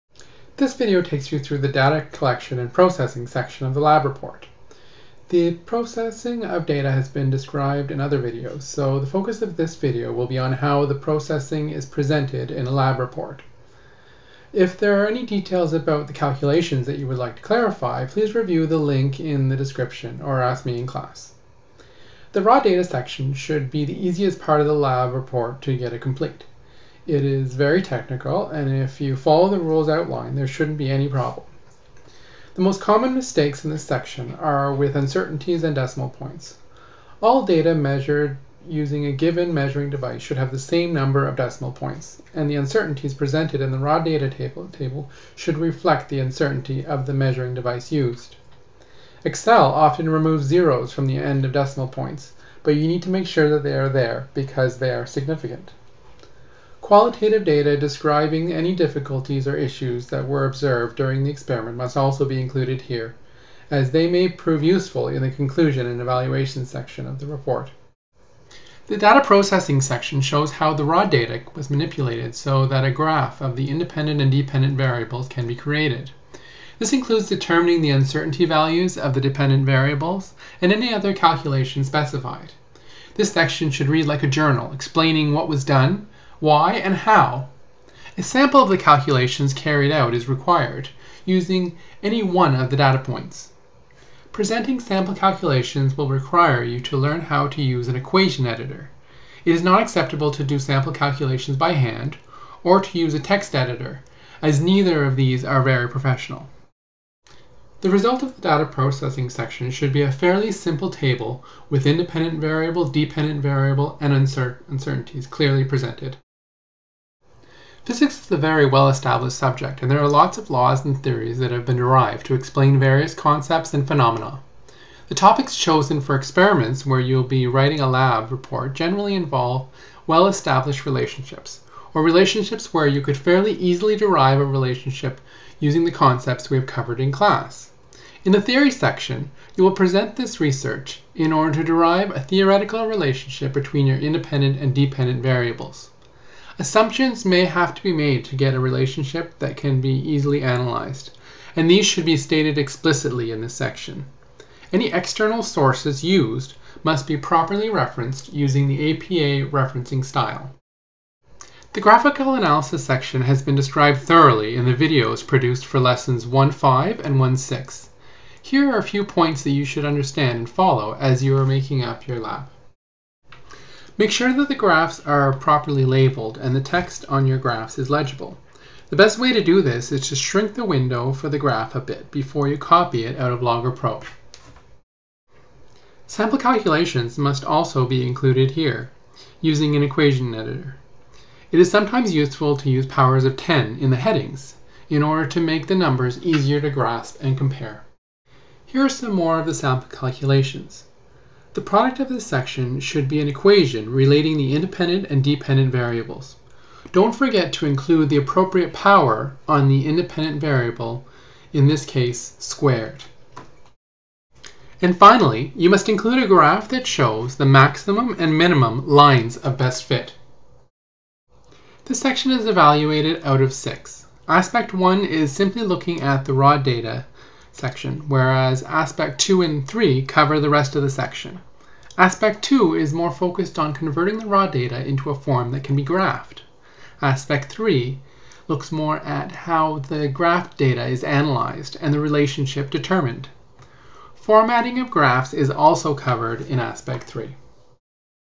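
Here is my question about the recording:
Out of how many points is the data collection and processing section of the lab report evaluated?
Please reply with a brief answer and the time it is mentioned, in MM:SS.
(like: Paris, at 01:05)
6, at 03:43.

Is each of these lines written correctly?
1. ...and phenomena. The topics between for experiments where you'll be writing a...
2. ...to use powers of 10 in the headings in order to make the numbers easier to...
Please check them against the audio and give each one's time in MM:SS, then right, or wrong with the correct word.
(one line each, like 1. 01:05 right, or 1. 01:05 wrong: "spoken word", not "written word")
1. 02:03 wrong: "chosen", not "between"
2. 03:12 right.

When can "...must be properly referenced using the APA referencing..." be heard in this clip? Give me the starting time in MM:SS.
02:36.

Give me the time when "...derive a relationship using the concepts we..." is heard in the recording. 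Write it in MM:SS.
02:13.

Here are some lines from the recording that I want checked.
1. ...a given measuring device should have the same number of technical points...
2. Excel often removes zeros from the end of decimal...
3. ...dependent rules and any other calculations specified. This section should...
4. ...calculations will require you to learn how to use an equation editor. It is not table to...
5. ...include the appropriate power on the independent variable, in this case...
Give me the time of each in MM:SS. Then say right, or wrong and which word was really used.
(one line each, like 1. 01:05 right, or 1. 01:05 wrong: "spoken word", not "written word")
1. 00:39 wrong: "decimal", not "technical"
2. 00:49 right
3. 01:19 wrong: "variables", not "rules"
4. 01:35 wrong: "acceptable", not "table"
5. 03:27 right.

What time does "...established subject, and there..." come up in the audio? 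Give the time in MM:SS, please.
01:58.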